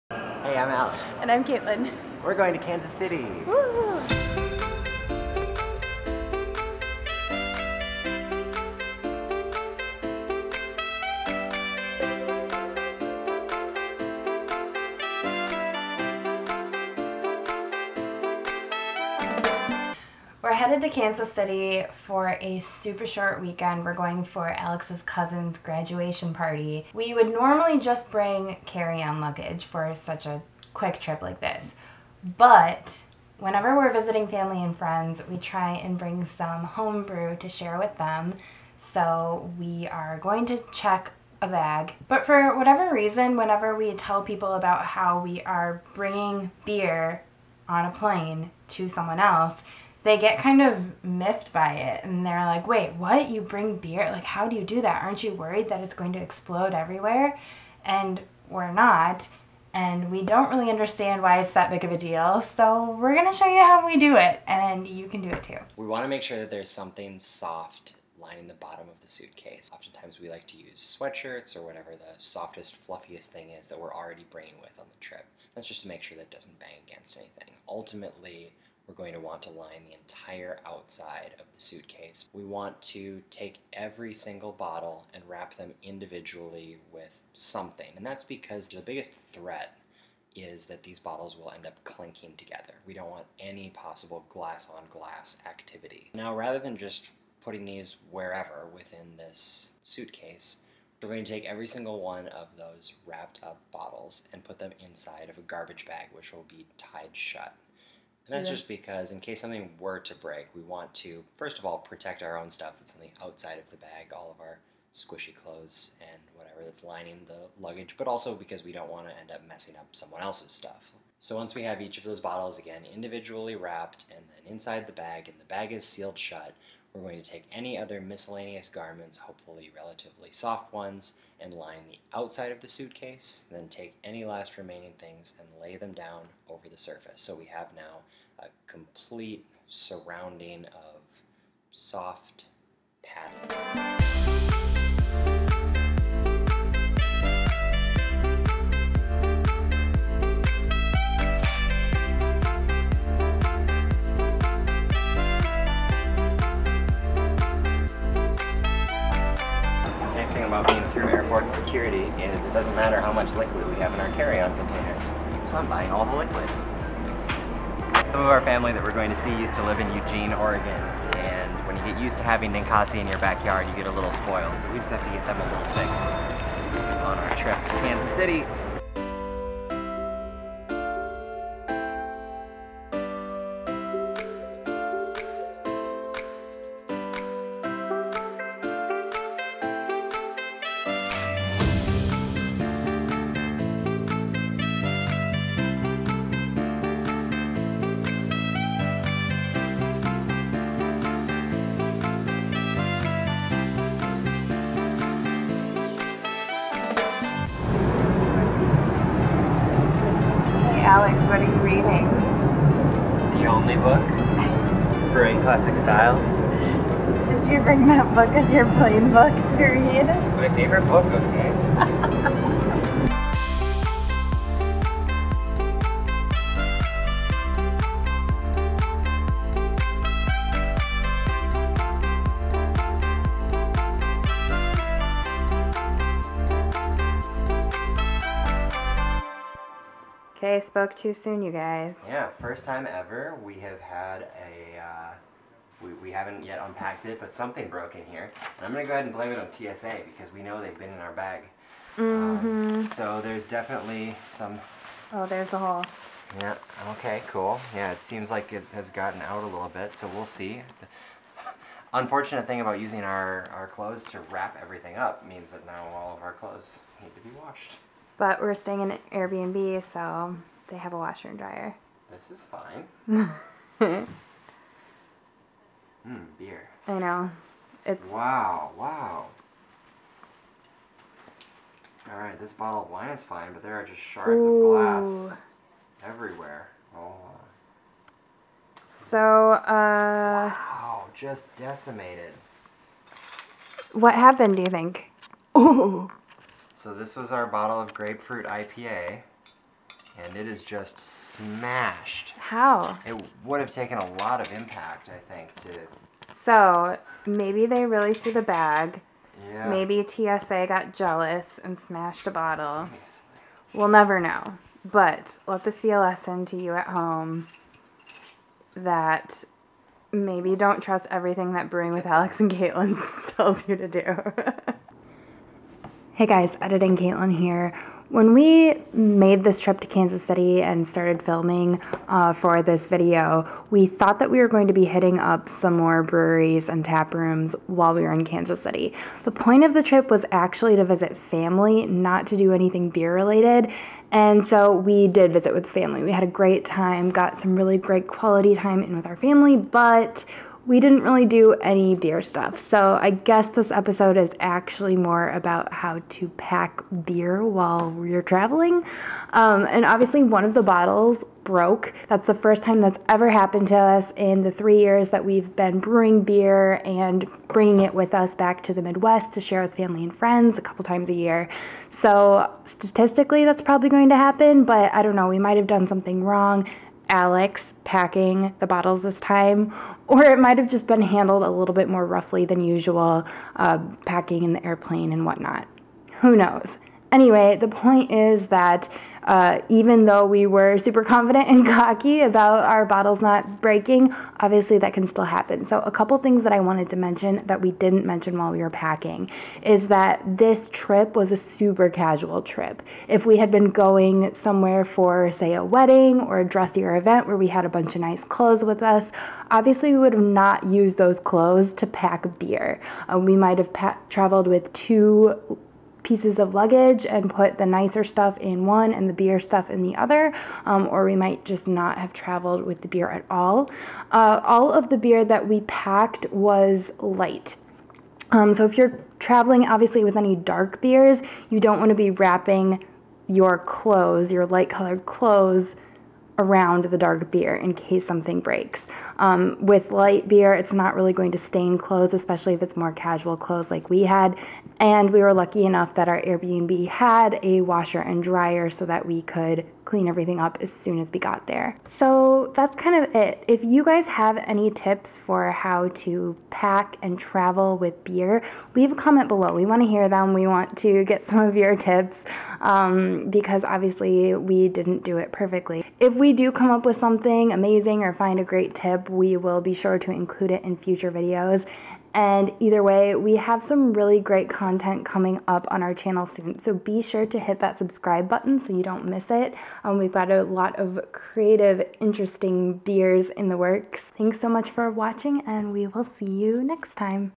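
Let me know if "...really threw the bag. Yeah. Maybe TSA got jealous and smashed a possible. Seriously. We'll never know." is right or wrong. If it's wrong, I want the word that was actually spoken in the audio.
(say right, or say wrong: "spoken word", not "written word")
wrong: "bottle", not "possible".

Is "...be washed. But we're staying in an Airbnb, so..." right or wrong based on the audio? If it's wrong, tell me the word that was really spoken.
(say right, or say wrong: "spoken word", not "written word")
right.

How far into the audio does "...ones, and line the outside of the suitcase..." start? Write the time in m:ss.
2:10.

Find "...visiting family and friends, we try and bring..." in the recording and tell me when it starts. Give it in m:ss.
0:33.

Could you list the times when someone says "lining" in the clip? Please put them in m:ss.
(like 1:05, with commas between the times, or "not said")
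1:08, 1:56.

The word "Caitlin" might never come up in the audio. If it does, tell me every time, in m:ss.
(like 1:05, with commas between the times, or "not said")
0:01, 5:22, 5:26.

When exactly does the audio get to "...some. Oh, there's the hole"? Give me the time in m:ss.
4:14.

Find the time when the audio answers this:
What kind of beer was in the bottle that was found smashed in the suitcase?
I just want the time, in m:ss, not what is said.
4:57.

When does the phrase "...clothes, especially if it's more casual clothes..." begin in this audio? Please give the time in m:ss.
7:21.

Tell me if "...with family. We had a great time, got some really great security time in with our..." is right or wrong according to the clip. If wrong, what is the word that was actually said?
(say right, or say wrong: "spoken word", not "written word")
wrong: "quality", not "security".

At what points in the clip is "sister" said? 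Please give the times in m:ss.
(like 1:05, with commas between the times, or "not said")
not said.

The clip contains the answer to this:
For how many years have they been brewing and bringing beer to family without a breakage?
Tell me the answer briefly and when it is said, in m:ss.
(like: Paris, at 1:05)
3, at 6:04.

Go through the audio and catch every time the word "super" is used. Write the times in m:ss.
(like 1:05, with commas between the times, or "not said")
0:22, 6:30, 6:41.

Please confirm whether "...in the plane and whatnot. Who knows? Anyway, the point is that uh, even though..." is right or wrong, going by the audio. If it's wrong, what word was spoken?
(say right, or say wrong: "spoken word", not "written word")
wrong: "airplane", not "plane".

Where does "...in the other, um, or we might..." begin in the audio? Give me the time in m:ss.
6:59.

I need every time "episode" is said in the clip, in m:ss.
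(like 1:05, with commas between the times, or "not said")
5:53.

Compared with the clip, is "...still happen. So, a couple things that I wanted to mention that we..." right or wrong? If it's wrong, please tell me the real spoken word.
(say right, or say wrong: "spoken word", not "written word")
right.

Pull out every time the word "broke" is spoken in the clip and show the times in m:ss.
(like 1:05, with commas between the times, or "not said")
4:07, 6:01.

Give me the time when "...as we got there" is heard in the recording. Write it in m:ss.
7:30.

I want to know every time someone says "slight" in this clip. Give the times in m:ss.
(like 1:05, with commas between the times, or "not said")
not said.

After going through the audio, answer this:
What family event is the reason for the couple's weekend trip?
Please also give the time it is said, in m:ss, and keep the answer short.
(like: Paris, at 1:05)
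Graduation party, at 0:25.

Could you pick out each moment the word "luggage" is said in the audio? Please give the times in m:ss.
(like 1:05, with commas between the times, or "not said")
0:29, 1:57, 6:56.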